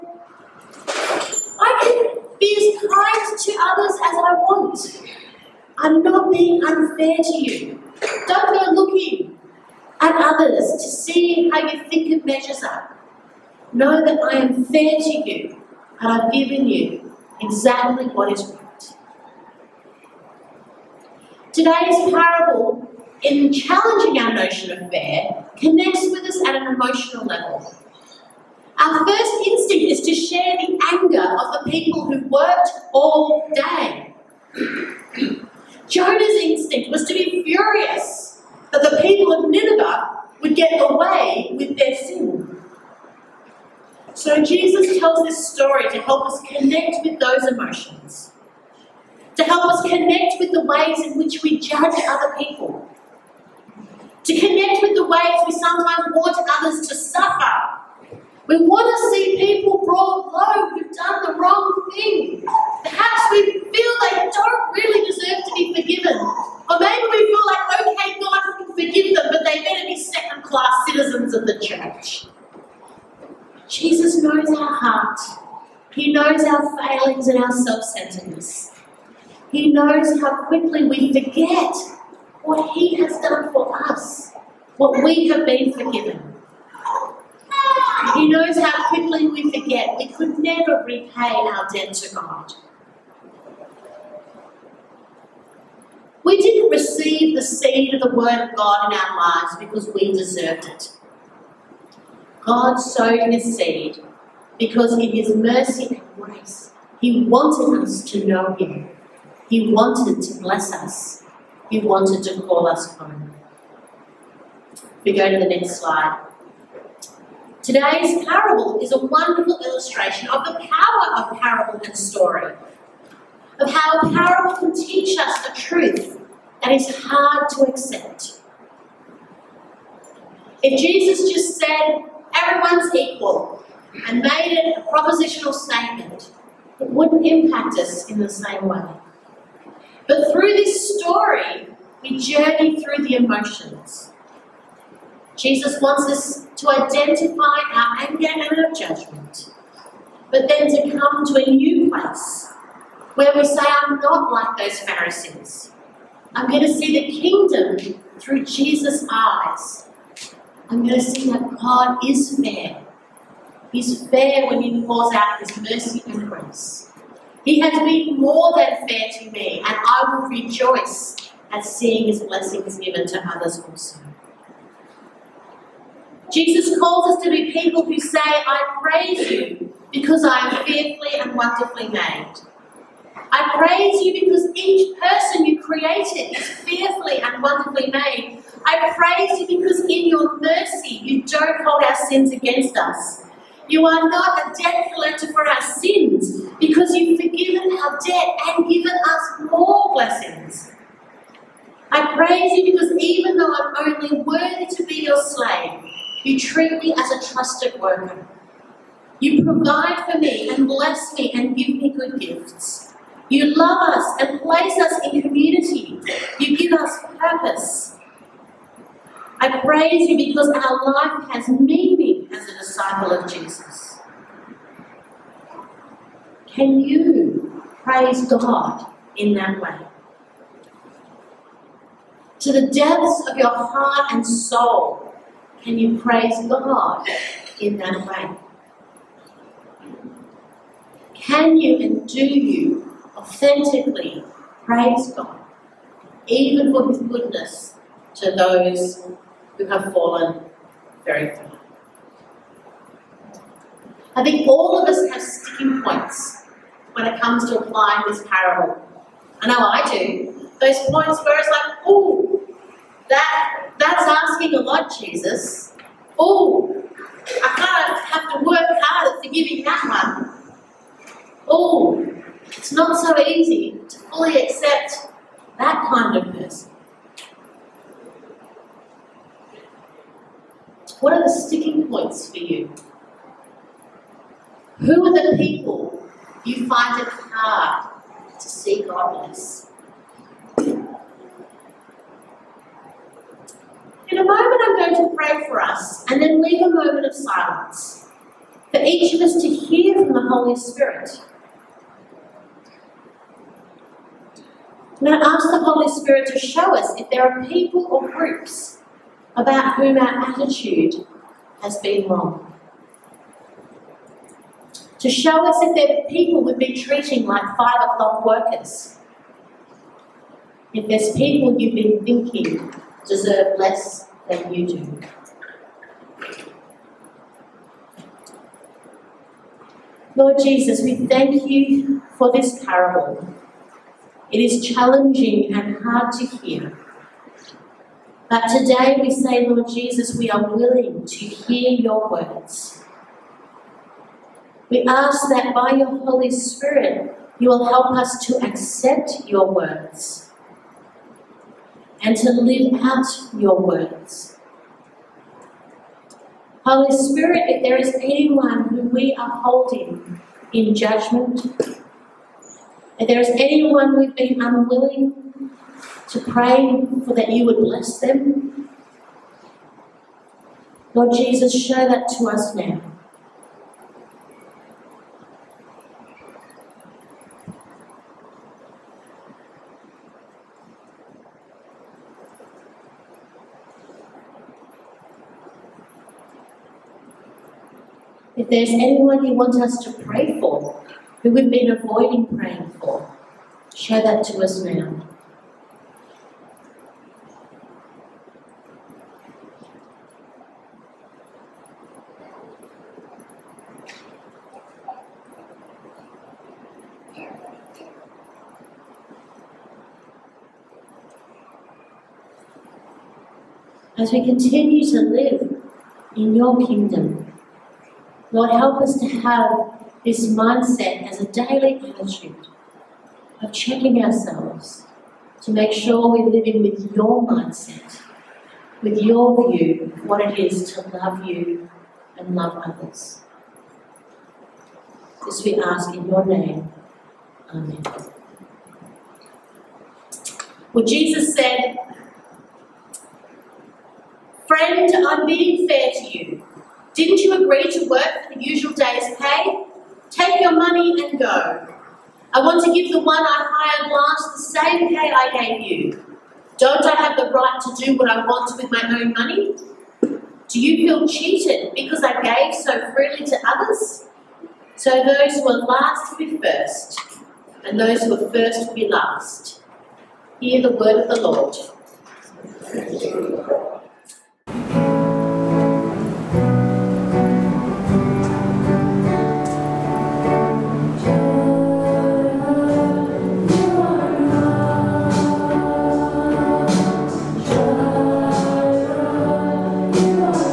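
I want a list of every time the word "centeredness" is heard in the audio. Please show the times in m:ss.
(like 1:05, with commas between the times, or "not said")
1:17.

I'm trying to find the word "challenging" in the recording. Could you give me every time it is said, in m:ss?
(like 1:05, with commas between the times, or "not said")
0:23, 5:34.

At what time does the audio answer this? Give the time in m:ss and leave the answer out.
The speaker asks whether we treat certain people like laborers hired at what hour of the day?
5:17.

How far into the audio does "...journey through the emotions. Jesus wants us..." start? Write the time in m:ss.
2:22.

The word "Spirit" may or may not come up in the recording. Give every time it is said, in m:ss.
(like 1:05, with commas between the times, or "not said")
5:00, 5:05, 5:46, 5:56.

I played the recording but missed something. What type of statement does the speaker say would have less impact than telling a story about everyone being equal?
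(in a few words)
propositional statement.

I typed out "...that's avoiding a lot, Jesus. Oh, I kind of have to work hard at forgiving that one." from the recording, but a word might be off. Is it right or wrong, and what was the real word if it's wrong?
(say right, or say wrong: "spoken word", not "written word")
wrong: "asking", not "avoiding".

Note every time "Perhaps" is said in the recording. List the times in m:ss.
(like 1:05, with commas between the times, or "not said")
1:02.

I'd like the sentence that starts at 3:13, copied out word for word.
You are not a debt collector for our sins because you've forgiven our debt and given us more blessings.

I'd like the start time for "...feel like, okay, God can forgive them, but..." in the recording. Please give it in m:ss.
1:07.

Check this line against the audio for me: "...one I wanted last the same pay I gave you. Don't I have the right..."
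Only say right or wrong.
wrong.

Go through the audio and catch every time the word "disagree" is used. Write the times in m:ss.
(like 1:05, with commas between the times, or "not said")
not said.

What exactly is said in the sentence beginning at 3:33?
You love us and place us in community.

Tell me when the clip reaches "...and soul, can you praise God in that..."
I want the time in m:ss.
3:54.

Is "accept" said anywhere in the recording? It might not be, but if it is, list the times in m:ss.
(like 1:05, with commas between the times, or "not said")
2:07, 4:34, 5:48.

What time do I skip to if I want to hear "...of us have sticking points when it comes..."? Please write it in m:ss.
4:14.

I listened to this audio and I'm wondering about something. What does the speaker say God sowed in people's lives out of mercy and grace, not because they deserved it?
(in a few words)
His seed.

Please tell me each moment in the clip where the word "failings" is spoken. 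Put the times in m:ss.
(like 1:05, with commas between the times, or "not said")
1:16.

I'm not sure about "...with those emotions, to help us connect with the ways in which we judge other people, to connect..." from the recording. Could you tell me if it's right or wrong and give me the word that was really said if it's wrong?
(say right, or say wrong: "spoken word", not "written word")
right.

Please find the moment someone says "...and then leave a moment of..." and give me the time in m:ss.
4:56.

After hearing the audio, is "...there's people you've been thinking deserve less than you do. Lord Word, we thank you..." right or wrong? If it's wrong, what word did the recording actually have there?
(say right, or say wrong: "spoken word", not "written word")
wrong: "Jesus", not "Word".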